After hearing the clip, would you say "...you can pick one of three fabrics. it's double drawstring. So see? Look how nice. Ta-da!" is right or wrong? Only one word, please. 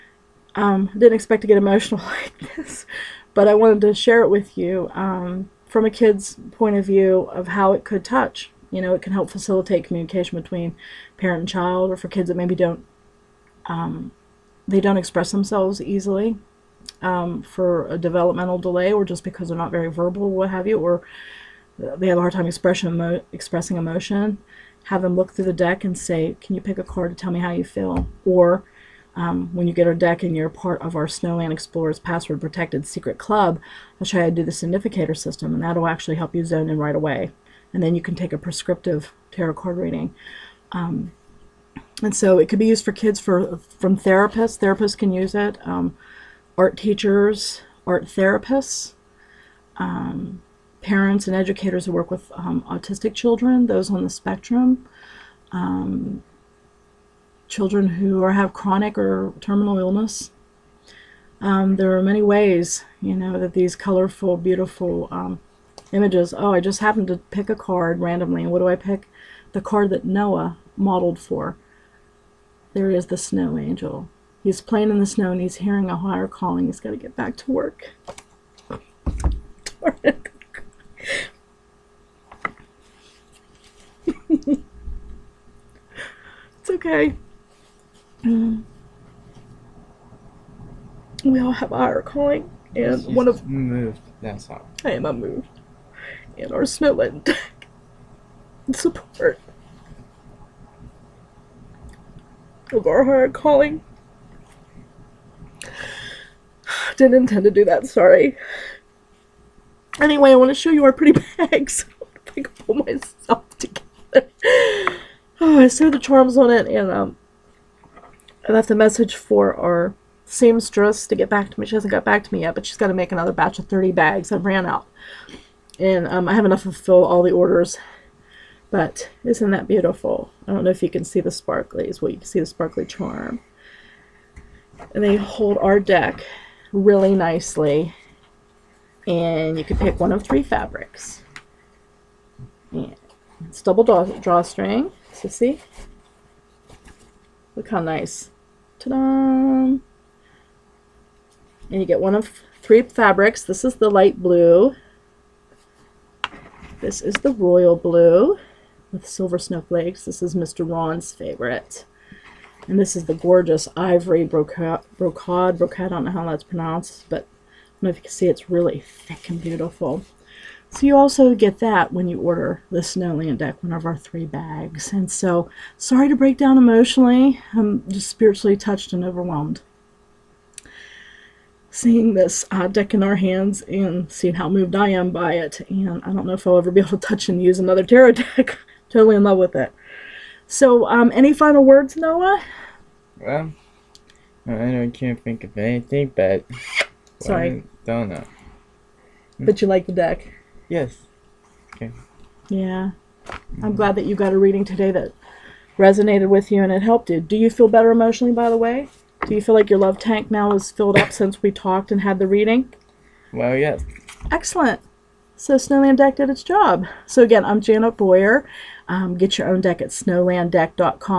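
right.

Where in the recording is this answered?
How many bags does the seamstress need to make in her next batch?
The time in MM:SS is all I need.
02:03.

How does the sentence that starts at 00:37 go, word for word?
And then you can take a prescriptive tarot card reading.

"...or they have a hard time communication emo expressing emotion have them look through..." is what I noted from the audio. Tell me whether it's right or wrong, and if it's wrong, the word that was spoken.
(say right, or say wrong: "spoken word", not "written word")
wrong: "expression", not "communication".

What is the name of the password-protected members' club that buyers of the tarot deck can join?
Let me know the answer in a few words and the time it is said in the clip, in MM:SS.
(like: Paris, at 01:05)
Snowland Explorers, at 00:31.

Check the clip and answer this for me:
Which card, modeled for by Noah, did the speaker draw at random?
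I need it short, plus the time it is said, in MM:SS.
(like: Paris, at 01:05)
The snow angel, at 01:13.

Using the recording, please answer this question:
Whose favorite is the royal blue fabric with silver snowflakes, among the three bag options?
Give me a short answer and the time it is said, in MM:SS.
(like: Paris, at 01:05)
Mr. Ron, at 02:40.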